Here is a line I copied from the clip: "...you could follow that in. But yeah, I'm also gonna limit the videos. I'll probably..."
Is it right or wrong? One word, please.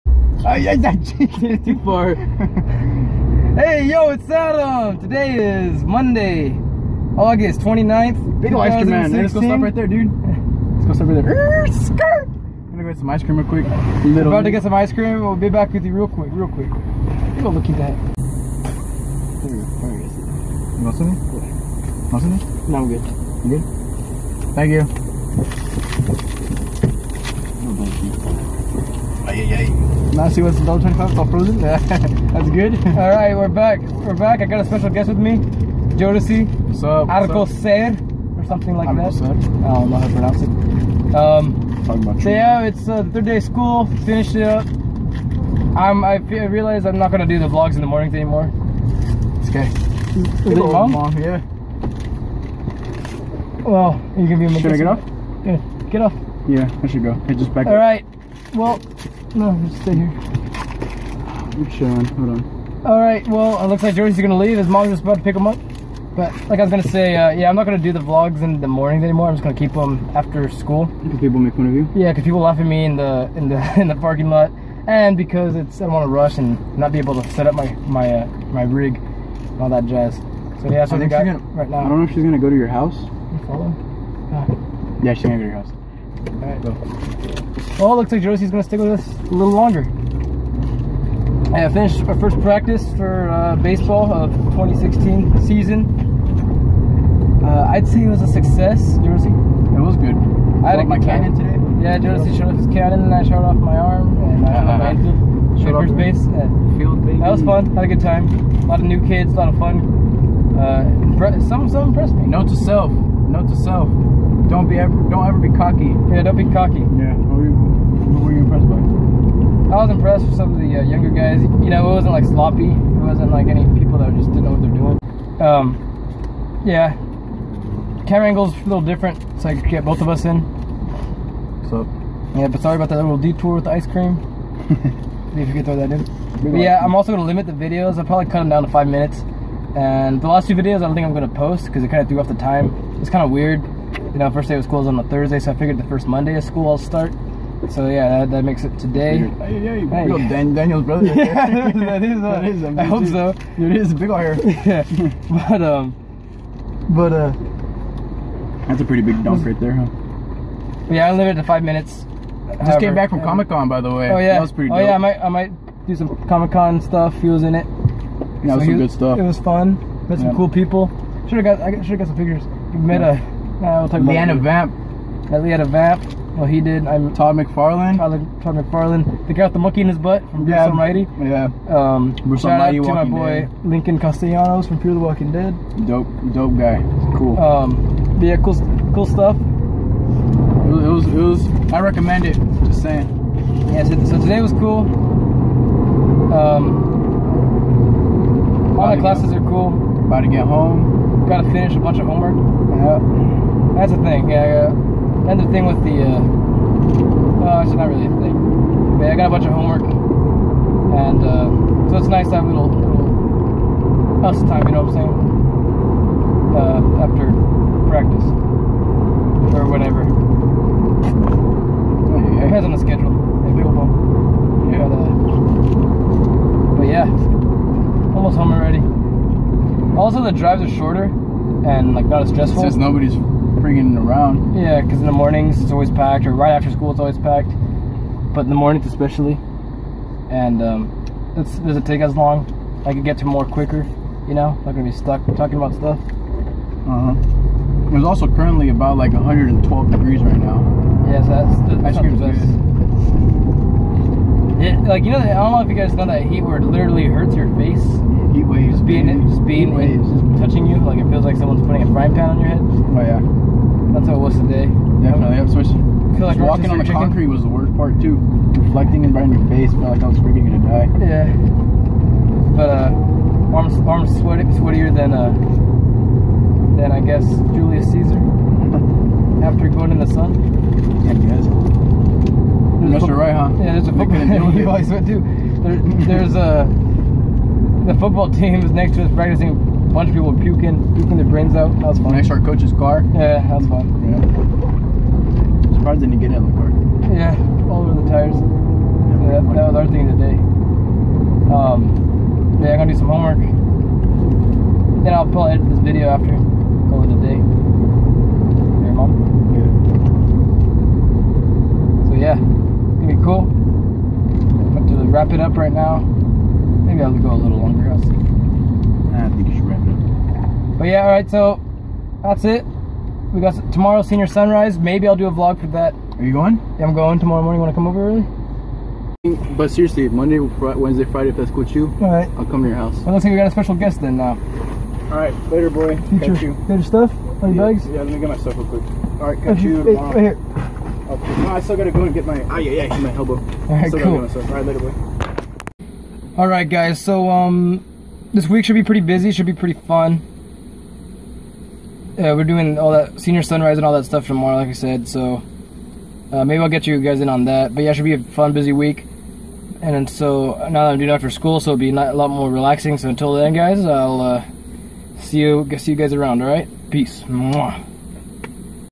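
wrong.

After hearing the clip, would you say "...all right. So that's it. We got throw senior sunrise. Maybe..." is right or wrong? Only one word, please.
wrong.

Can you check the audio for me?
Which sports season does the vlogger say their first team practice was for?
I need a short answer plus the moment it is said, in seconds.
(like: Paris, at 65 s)
2016, at 94 s.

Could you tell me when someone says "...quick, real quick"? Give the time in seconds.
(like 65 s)
16 s.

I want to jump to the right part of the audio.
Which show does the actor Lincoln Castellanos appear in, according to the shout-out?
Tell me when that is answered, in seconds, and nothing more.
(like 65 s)
184 s.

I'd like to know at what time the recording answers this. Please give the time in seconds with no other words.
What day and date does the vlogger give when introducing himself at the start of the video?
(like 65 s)
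5 s.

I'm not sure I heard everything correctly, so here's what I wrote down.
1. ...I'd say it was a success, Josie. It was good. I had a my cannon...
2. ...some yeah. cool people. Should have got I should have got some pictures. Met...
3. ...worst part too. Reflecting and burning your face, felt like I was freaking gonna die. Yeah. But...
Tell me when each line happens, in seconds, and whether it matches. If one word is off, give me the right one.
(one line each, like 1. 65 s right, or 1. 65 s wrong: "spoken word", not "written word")
1. 97 s right
2. 170 s right
3. 267 s right.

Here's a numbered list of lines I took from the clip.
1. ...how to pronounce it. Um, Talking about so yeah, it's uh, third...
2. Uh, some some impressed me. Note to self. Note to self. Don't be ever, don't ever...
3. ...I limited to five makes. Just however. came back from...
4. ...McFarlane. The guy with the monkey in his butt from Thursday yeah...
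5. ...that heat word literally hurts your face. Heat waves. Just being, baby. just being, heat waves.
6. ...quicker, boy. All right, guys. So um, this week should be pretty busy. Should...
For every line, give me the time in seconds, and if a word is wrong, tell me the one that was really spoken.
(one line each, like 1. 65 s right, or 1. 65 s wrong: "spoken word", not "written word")
1. 39 s right
2. 110 s right
3. 161 s wrong: "minutes", not "makes"
4. 178 s wrong: "Bruce", not "Thursday"
5. 256 s right
6. 344 s wrong: "later", not "quicker".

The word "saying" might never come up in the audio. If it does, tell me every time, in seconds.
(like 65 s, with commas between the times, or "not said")
192 s, 214 s.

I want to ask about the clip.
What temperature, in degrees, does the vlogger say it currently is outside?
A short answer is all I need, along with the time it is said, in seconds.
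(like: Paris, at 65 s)
112, at 249 s.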